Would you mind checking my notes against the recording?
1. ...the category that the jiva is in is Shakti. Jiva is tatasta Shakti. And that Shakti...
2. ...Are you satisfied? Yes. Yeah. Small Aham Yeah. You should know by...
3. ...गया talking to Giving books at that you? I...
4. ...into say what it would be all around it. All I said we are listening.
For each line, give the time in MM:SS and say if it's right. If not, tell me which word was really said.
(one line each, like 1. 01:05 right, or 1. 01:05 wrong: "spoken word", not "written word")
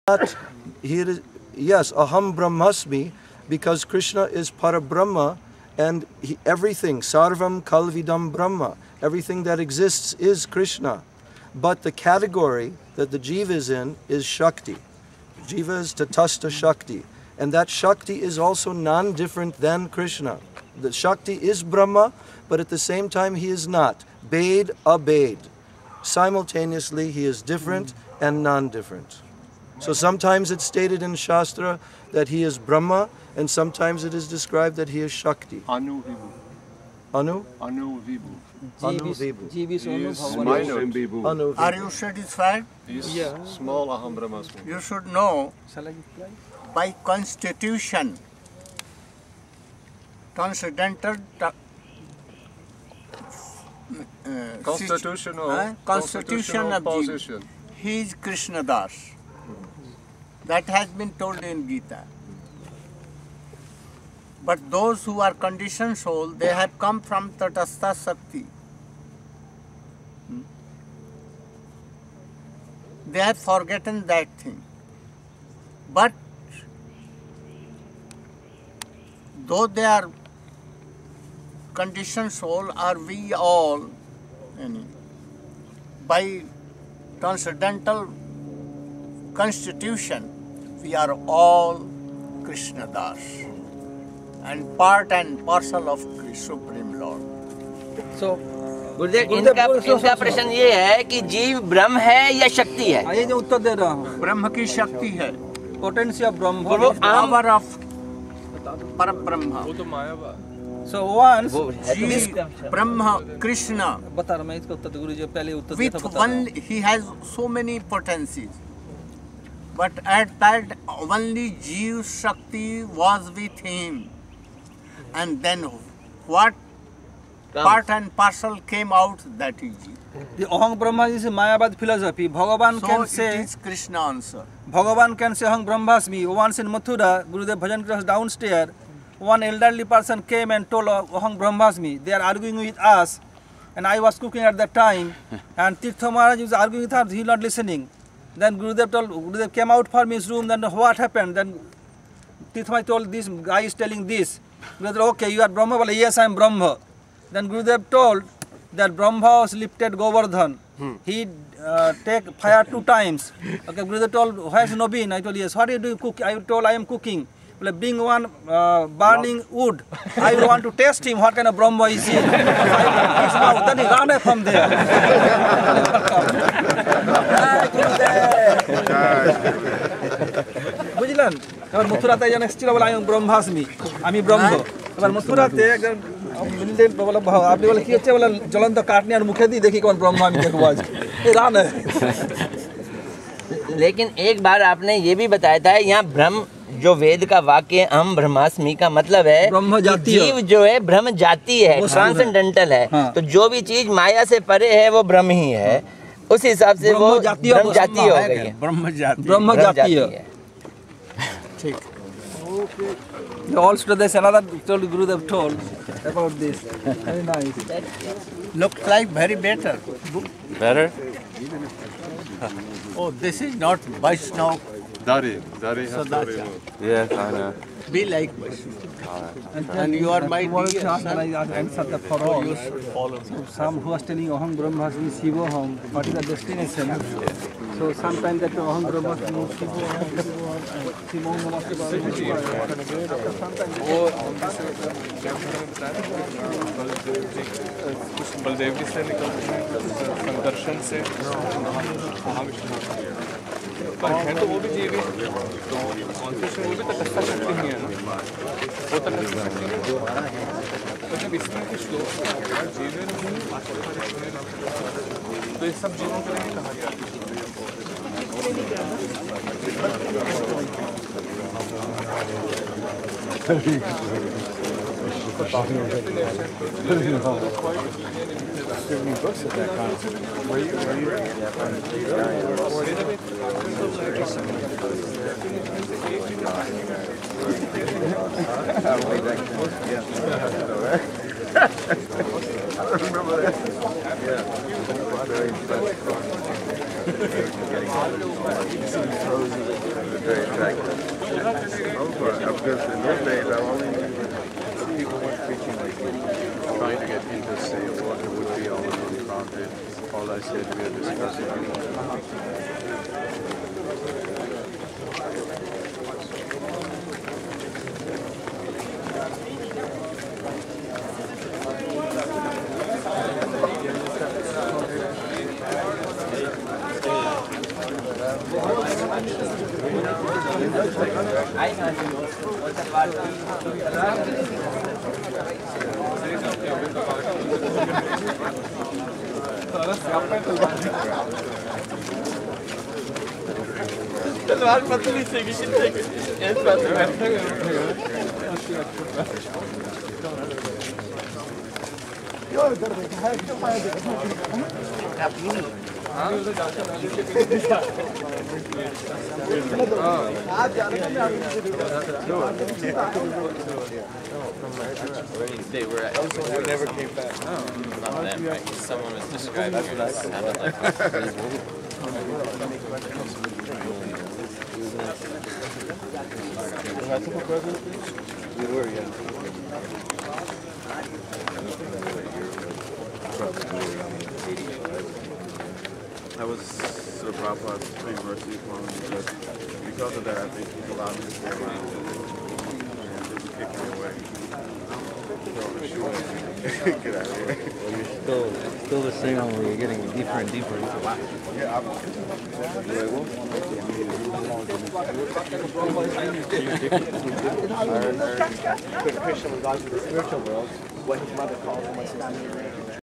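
1. 00:11 right
2. 00:41 wrong: "Brahmasmi", not "Yeah"
3. 04:33 right
4. 05:07 wrong: "discussing", not "listening".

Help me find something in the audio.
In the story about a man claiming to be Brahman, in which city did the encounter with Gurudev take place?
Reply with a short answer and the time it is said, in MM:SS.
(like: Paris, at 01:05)
Mathura, at 02:16.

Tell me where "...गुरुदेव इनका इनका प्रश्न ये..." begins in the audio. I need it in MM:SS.
01:38.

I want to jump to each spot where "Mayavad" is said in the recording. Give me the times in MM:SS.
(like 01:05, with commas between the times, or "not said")
02:11.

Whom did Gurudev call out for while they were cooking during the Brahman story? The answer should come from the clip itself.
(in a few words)
Nobin.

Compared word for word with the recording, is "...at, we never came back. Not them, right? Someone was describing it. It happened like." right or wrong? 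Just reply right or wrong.
wrong.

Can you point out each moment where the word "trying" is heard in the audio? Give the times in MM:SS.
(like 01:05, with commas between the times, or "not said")
05:06.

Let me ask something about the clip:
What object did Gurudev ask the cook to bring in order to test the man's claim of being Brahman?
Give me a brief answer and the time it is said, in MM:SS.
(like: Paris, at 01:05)
Burning wood, at 02:48.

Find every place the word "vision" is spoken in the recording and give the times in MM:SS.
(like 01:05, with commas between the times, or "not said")
not said.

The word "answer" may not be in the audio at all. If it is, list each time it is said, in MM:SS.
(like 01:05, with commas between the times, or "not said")
02:14, 03:51.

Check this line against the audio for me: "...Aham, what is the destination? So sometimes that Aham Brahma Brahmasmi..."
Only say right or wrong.
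right.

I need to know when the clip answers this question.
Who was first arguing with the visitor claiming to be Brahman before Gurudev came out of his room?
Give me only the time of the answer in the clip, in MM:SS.
02:25.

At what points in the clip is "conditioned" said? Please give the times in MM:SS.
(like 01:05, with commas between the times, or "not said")
01:05, 01:21.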